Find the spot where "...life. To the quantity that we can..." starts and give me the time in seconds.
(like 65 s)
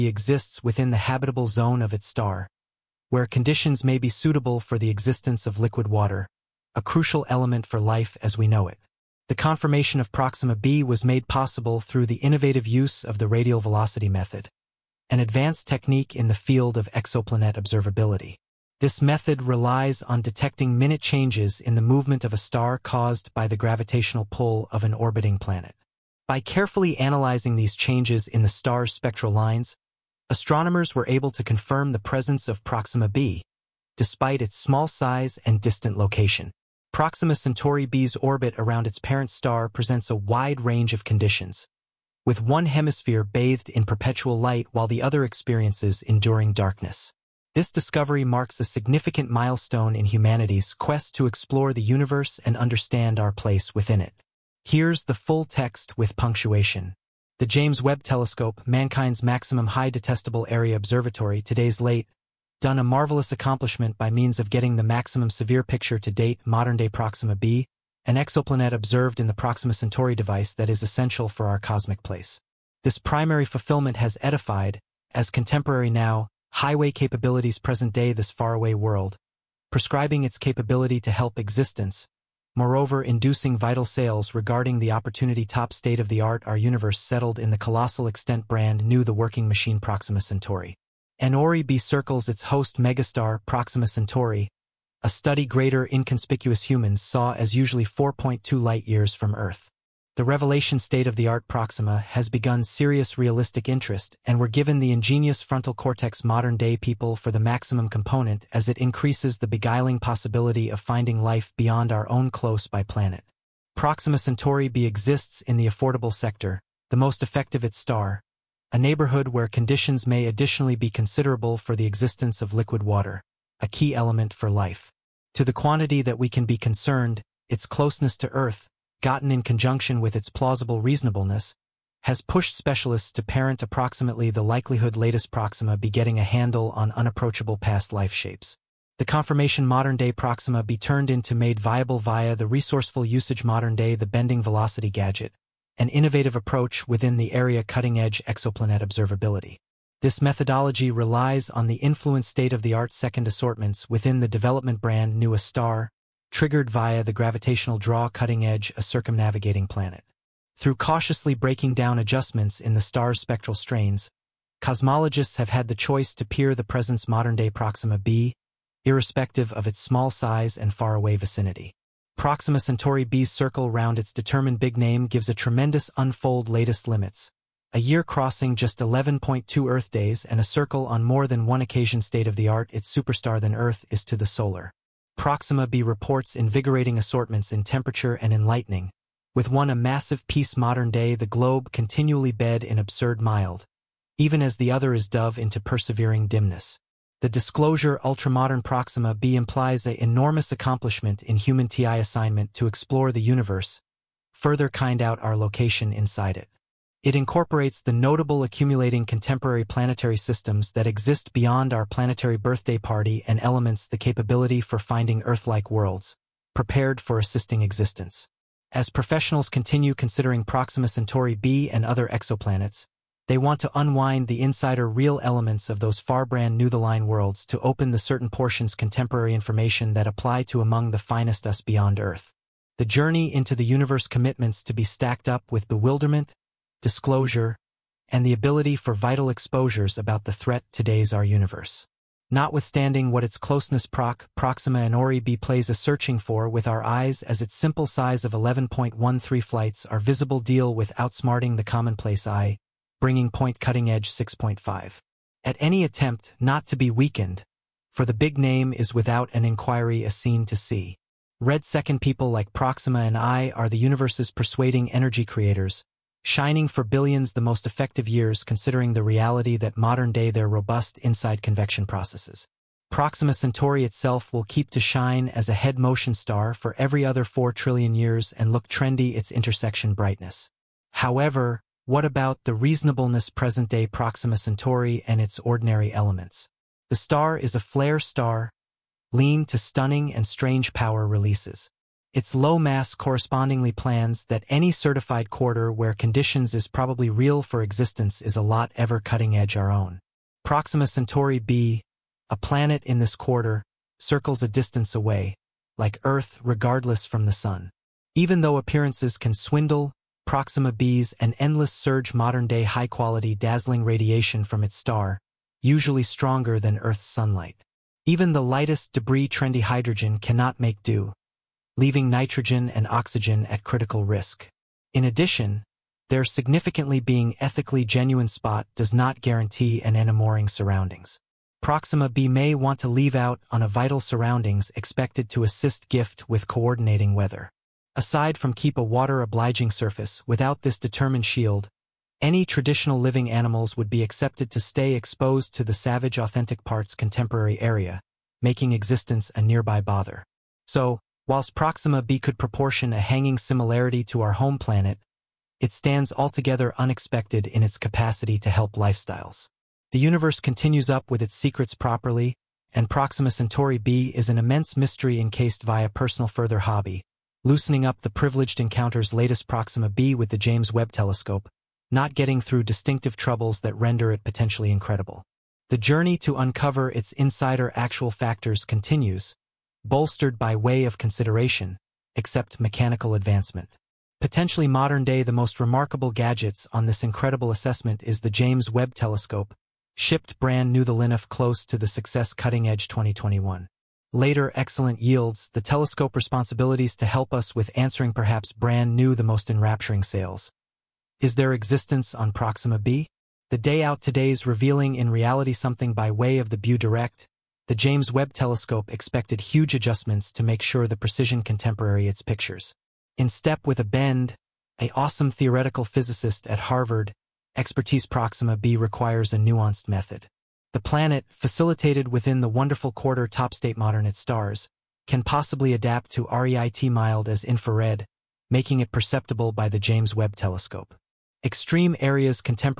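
124 s.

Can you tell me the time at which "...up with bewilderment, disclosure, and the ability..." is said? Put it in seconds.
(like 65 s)
235 s.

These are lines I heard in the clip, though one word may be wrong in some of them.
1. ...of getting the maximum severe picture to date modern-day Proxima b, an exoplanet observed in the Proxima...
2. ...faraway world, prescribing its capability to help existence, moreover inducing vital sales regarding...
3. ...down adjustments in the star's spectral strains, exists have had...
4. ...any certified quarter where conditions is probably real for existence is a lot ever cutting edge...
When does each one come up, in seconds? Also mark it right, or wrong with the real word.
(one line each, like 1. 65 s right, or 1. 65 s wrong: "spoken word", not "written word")
1. 64 s right
2. 78 s right
3. 161 s wrong: "cosmologists", not "exists"
4. 294 s right.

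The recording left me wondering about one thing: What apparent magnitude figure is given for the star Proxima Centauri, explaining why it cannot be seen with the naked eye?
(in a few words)
11.13.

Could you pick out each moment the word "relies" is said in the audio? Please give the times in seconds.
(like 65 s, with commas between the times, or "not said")
19 s, 150 s.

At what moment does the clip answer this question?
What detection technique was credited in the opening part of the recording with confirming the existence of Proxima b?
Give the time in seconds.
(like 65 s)
13 s.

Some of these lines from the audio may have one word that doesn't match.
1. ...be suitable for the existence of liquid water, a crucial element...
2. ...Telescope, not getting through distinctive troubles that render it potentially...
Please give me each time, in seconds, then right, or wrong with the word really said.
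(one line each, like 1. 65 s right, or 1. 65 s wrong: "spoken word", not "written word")
1. 3 s right
2. 370 s right.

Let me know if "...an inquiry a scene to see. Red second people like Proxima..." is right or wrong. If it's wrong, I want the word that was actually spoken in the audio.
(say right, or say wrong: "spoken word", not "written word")
right.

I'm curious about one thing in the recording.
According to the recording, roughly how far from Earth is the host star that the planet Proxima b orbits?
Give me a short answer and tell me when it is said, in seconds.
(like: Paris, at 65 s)
4.2 light-years, at 97 s.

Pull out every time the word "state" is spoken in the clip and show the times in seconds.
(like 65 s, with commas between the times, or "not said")
85 s, 100 s, 152 s, 182 s, 423 s.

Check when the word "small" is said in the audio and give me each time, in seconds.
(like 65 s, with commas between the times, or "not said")
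34 s, 169 s.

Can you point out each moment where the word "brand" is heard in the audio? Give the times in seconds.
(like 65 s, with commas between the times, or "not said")
88 s, 154 s, 226 s, 390 s, 398 s.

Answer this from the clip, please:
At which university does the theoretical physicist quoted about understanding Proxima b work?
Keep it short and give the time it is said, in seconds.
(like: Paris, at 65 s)
Harvard, at 416 s.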